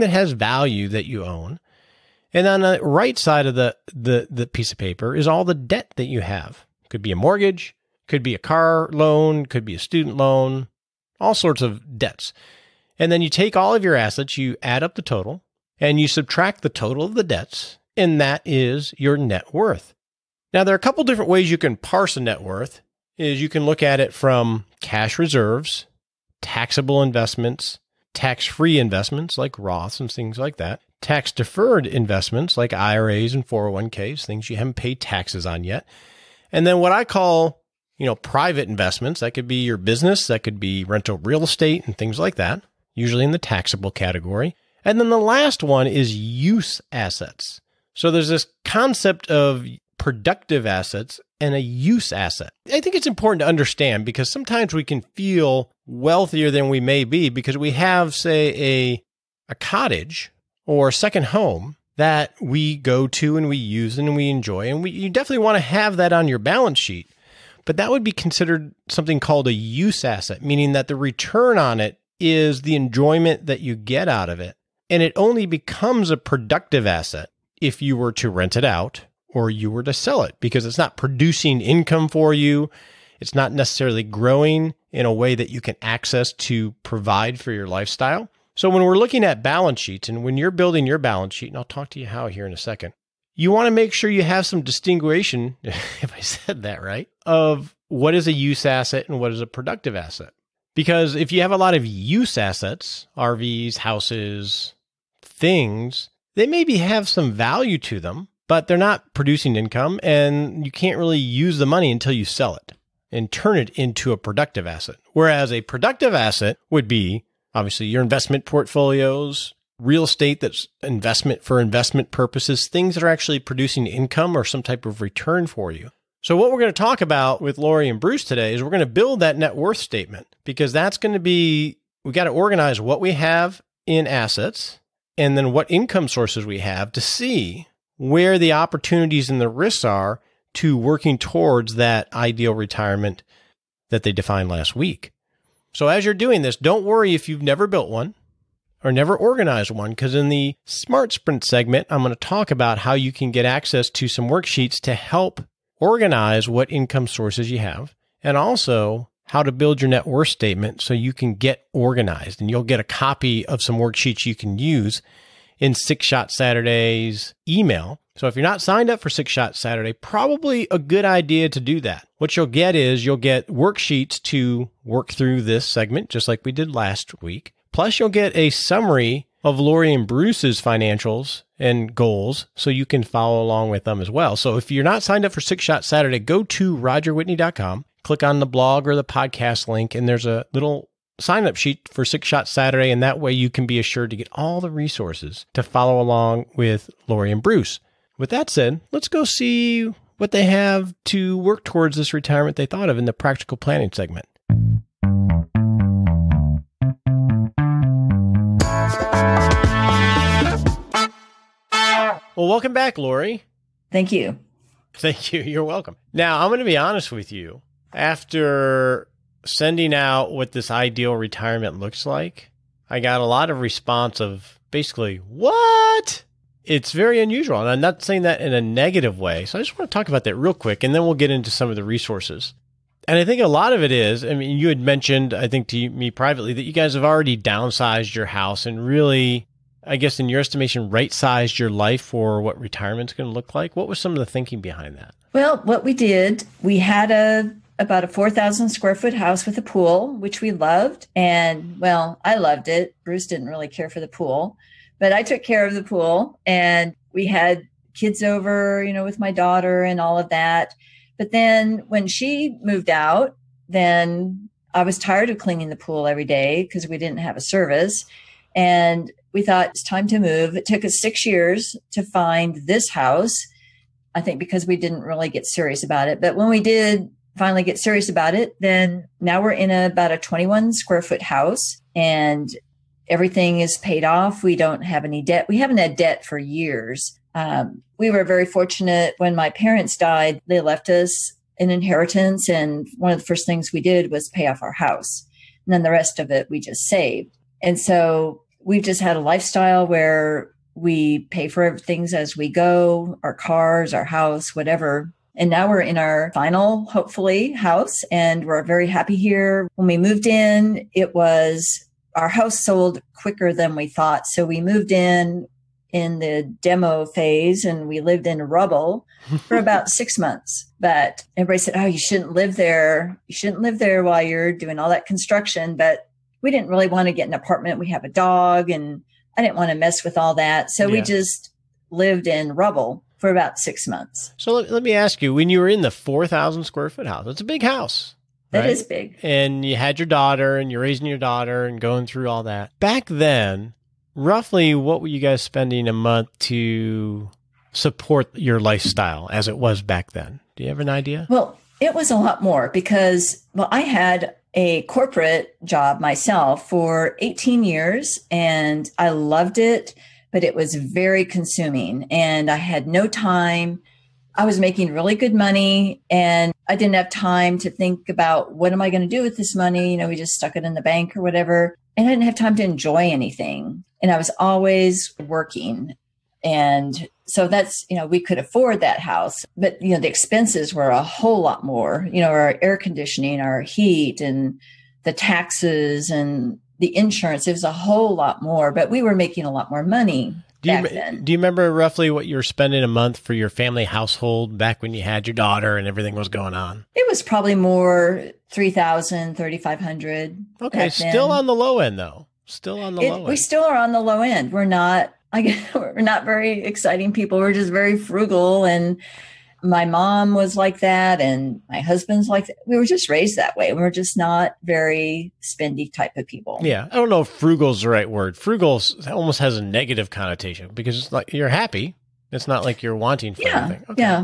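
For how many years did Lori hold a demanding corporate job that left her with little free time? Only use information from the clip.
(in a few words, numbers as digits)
18.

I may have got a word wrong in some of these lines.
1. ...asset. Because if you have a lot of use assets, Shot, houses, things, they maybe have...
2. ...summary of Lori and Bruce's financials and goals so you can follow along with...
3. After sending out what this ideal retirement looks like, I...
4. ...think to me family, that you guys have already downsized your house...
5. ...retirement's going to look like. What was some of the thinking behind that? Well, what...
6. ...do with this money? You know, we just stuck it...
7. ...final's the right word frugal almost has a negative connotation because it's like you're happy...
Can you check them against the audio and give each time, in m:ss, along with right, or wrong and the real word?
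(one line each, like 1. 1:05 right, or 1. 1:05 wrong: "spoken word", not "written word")
1. 1:39 wrong: "RVs", not "Shot"
2. 2:58 right
3. 3:37 right
4. 3:55 wrong: "privately", not "family"
5. 4:02 right
6. 6:09 right
7. 6:57 wrong: "frugal", not "final".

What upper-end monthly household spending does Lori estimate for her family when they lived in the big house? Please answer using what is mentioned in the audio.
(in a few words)
3,500.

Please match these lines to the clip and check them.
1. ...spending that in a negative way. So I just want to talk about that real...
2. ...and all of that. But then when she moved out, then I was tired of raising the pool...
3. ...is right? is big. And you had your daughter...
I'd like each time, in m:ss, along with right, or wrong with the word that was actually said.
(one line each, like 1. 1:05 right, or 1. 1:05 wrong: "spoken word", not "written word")
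1. 3:48 wrong: "saying", not "spending"
2. 4:19 wrong: "cleaning", not "raising"
3. 5:38 right.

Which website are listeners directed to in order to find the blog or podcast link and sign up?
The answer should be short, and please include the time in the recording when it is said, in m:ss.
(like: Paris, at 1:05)
rogerwhitney.com, at 3:06.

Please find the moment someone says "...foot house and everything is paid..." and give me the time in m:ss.
4:41.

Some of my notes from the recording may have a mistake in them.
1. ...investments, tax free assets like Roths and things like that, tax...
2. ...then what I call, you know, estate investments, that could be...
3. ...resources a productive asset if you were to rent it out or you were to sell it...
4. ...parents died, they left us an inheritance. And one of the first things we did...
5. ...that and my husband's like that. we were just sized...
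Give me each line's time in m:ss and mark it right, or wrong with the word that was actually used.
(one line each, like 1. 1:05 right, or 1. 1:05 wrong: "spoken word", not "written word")
1. 0:27 wrong: "investments", not "assets"
2. 0:36 wrong: "private", not "estate"
3. 1:15 wrong: "becomes", not "resources"
4. 4:49 right
5. 6:50 wrong: "raised", not "sized".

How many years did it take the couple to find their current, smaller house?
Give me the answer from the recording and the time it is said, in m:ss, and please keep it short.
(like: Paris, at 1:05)
6, at 4:30.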